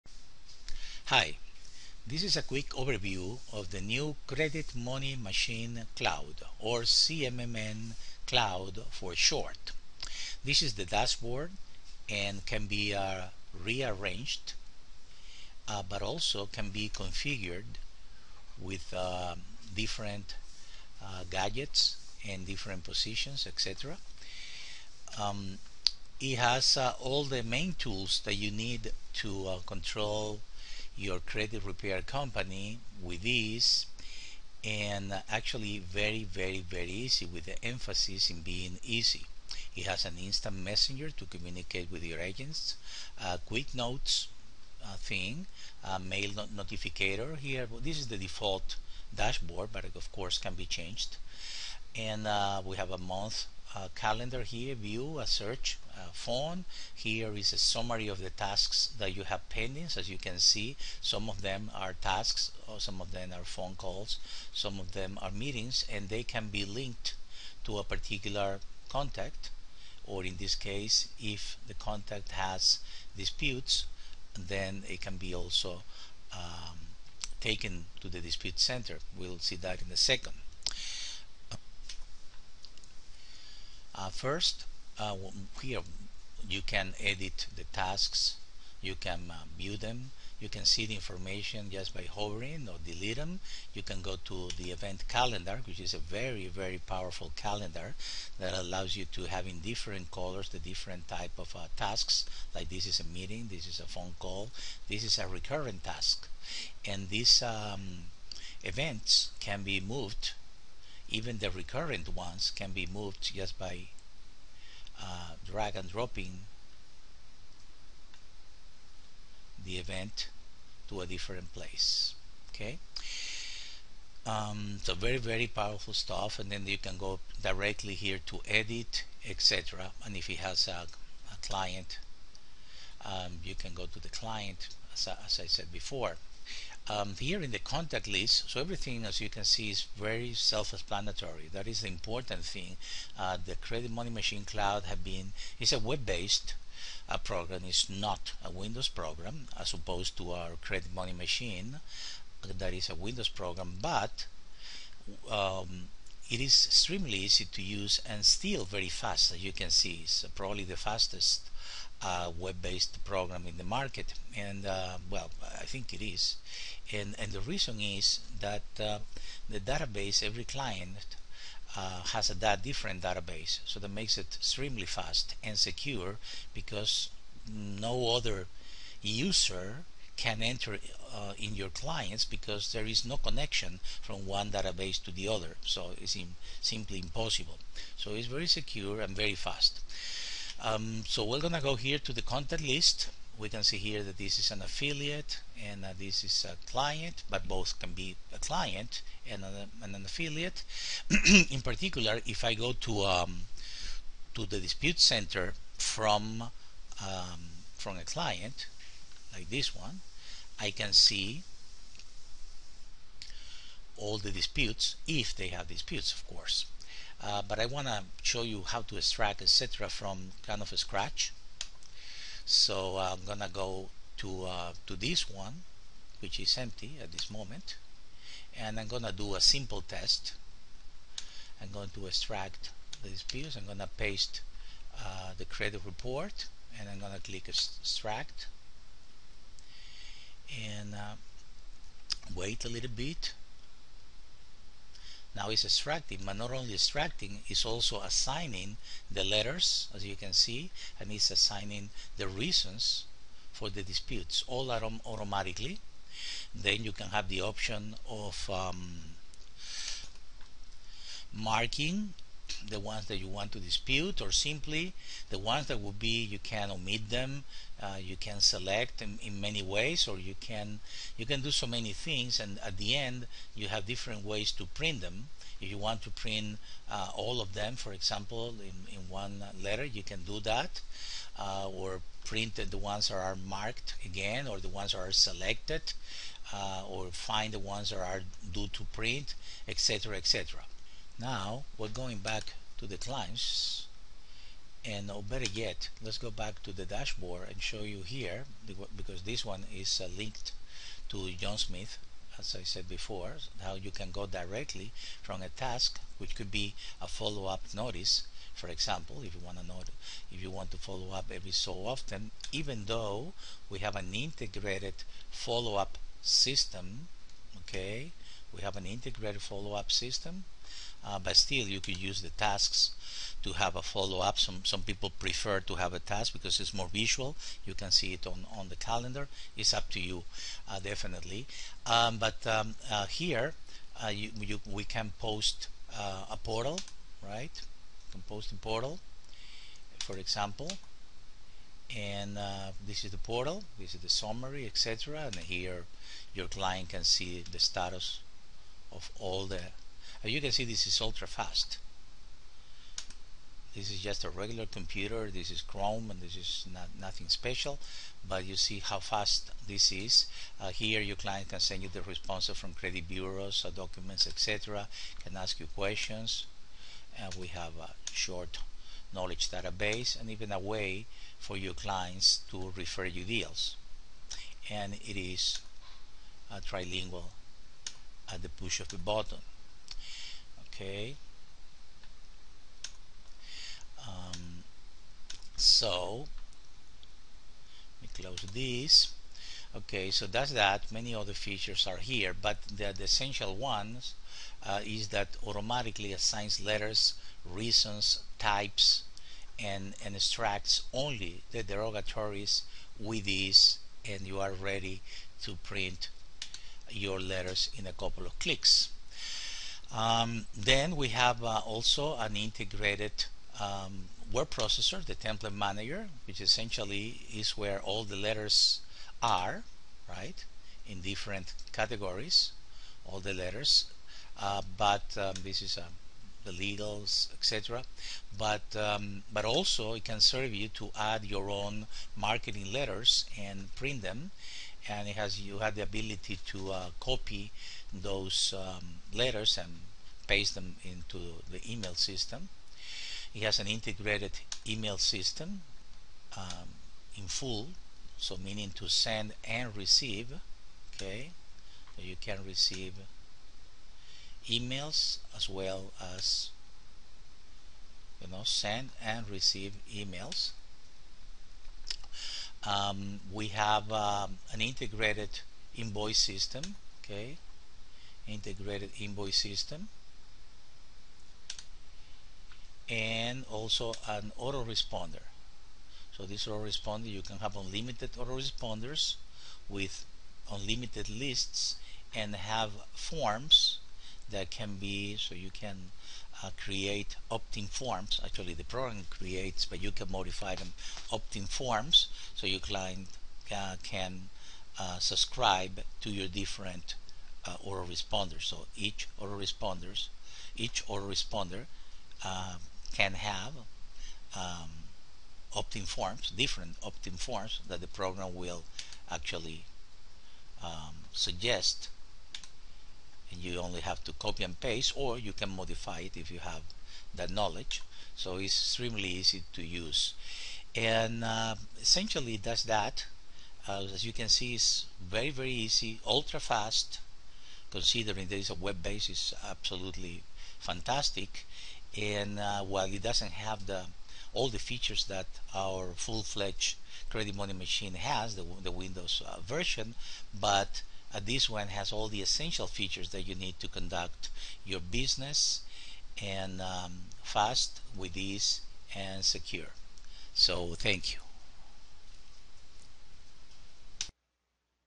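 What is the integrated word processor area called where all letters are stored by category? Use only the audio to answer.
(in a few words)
Template manager.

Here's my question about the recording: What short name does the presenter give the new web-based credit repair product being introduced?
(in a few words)
CMMN Cloud.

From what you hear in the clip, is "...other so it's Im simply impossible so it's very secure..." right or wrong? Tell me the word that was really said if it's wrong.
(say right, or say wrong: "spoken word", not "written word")
right.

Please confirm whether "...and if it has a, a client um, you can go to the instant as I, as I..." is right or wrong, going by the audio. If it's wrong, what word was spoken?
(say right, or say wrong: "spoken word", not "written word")
wrong: "client", not "instant".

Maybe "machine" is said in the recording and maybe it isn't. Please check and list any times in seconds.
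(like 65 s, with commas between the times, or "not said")
5 s, 144 s, 151 s, 537 s.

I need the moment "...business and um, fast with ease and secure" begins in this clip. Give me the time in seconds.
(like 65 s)
544 s.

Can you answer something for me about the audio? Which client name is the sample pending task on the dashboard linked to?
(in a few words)
John Smith.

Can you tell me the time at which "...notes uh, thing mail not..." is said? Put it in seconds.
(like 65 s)
43 s.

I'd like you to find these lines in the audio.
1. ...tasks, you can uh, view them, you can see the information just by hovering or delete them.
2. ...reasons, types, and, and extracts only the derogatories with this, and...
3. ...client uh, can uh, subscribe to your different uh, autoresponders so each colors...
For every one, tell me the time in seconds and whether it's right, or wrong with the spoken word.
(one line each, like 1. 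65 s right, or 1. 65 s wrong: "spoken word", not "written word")
1. 87 s right
2. 397 s right
3. 492 s wrong: "autoresponders", not "colors".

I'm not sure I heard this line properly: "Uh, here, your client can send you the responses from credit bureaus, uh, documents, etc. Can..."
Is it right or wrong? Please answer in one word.
right.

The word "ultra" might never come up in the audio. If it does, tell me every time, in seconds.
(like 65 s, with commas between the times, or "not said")
351 s, 526 s.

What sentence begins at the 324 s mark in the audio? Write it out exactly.
Some, some people prefer to have a task because it's more visual.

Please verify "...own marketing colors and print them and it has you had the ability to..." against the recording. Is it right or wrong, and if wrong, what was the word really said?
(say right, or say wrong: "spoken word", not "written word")
wrong: "letters", not "colors".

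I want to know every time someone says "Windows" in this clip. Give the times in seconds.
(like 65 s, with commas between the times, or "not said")
148 s, 152 s, 538 s.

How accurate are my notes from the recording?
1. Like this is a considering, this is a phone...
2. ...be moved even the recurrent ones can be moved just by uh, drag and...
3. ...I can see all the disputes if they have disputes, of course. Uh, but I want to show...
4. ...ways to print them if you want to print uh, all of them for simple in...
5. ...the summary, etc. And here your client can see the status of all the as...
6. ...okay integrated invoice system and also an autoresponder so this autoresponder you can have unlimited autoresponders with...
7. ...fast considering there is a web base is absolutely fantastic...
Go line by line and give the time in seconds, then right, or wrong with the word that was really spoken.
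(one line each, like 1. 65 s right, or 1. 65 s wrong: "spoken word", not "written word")
1. 102 s wrong: "meeting", not "considering"
2. 109 s right
3. 210 s right
4. 274 s wrong: "example", not "simple"
5. 344 s right
6. 467 s right
7. 526 s right.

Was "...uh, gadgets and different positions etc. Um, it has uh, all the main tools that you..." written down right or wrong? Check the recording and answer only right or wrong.
right.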